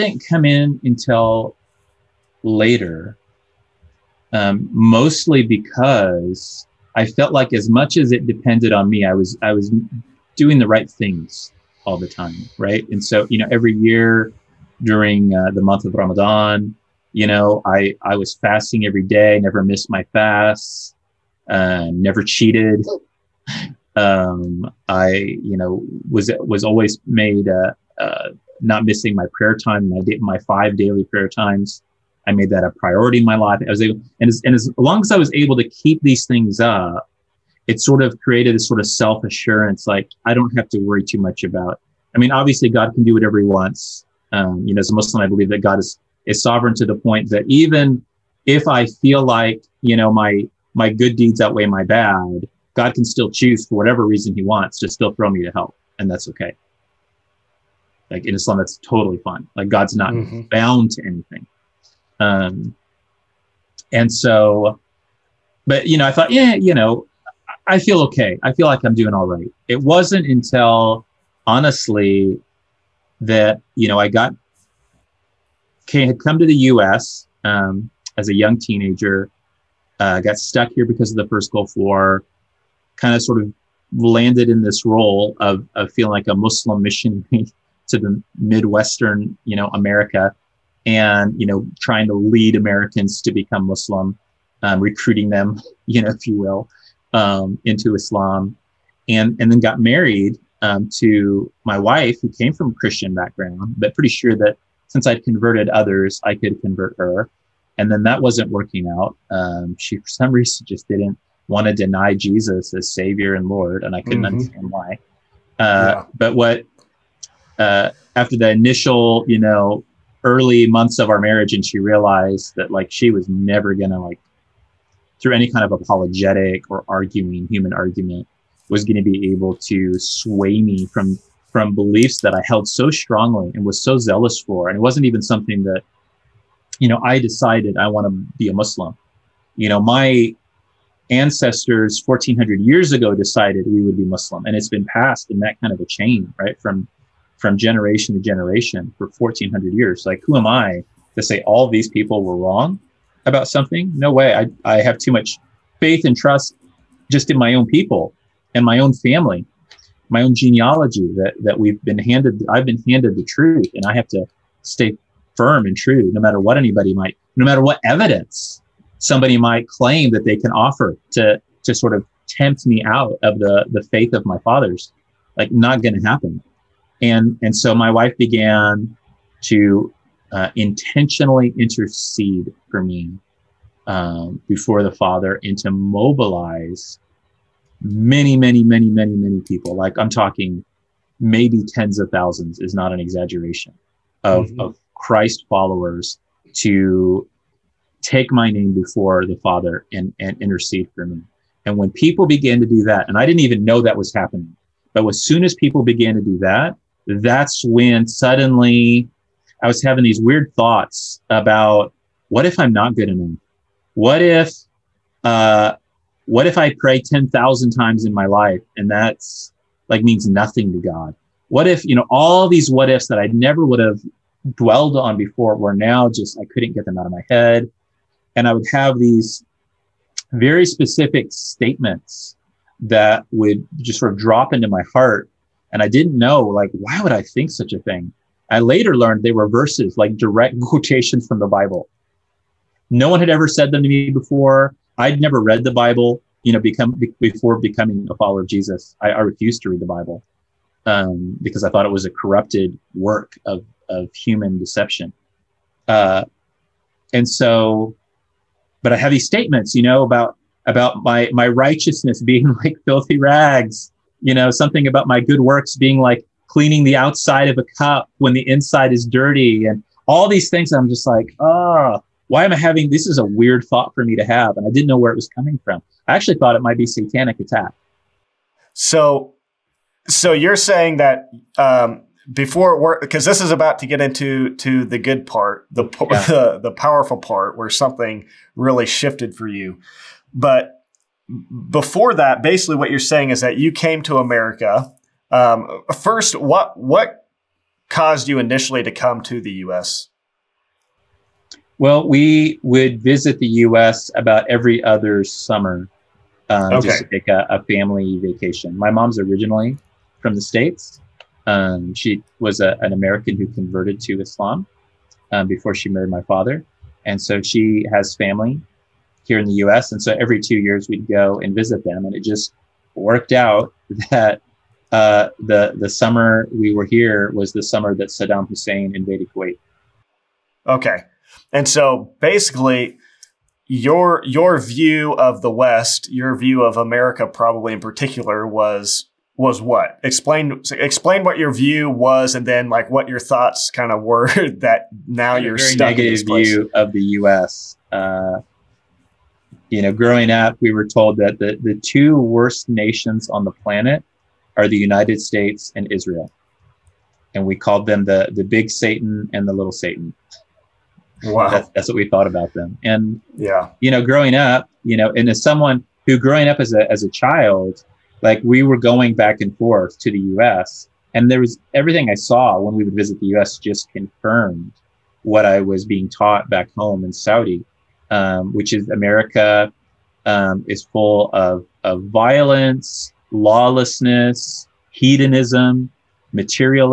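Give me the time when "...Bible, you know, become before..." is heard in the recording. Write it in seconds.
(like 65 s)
245 s.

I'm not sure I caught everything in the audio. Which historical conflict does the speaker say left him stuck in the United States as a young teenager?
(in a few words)
The first Gulf War.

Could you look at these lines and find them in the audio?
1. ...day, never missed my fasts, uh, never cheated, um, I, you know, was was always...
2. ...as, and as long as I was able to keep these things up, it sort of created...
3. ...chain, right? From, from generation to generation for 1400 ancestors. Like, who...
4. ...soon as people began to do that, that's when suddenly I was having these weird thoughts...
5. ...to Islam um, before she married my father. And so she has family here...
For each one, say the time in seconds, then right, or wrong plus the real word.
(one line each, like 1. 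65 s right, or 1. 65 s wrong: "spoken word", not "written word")
1. 19 s right
2. 34 s right
3. 145 s wrong: "years", not "ancestors"
4. 205 s right
5. 314 s right.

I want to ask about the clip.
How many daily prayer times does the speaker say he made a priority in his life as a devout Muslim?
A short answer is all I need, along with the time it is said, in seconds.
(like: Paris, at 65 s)
5, at 30 s.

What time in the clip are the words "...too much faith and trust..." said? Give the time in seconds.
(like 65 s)
154 s.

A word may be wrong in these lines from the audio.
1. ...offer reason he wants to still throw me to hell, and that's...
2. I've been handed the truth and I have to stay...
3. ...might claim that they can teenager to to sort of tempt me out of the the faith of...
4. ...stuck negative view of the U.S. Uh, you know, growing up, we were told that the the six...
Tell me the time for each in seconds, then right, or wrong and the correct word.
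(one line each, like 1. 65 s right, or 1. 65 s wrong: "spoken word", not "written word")
1. 53 s wrong: "whatever", not "offer"
2. 162 s right
3. 169 s wrong: "offer", not "teenager"
4. 345 s wrong: "two", not "six".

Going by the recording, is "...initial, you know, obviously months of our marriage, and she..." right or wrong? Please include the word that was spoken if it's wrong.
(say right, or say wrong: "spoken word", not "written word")
wrong: "early", not "obviously".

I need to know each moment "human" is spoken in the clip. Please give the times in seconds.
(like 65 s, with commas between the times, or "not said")
127 s, 254 s.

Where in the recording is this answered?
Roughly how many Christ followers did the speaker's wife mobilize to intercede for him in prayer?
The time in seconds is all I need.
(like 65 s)
191 s.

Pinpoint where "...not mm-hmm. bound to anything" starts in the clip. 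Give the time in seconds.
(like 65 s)
59 s.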